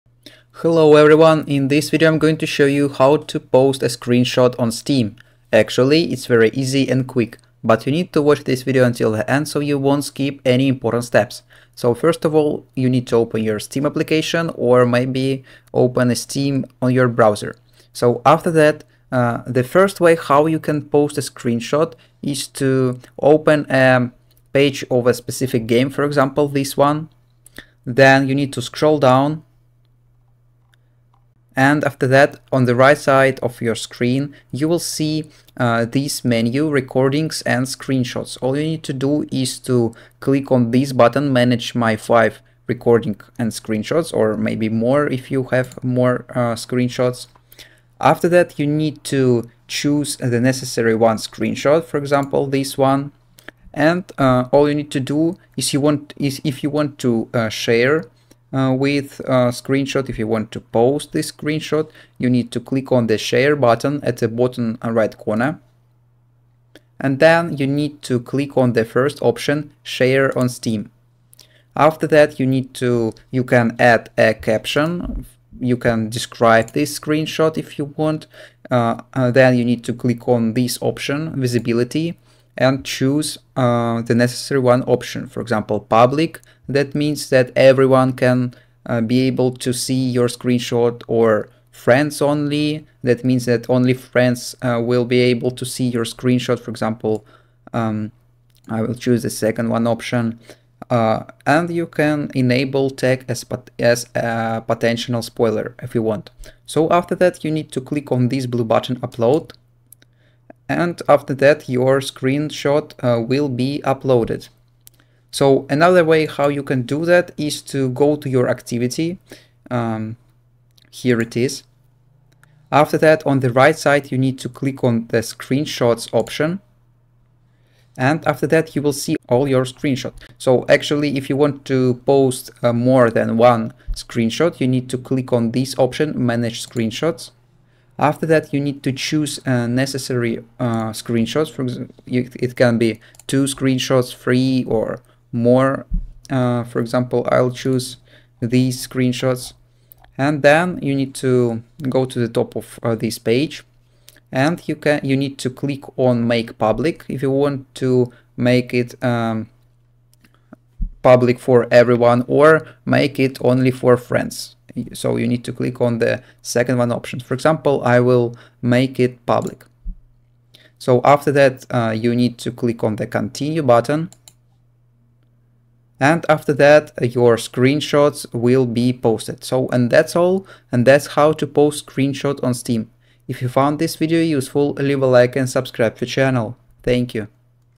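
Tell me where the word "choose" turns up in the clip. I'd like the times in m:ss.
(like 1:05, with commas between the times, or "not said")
0:49, 1:22, 1:38, 2:18, 2:27.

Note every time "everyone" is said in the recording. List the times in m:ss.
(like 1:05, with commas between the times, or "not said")
0:00, 1:27, 2:41.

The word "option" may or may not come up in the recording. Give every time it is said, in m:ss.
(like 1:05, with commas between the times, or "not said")
1:09, 1:20, 1:24, 1:39, 2:06, 2:15, 2:46.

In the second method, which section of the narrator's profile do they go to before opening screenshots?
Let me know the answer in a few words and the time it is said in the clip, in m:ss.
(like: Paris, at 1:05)
activity, at 1:58.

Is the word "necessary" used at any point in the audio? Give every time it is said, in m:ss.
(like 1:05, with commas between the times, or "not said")
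0:50, 1:24, 2:19.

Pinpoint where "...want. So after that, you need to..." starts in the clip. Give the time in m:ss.
1:46.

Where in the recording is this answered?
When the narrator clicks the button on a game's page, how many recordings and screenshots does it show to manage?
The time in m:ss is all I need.
0:41.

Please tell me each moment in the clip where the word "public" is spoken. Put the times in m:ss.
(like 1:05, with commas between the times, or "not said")
1:25, 2:36, 2:41, 2:49.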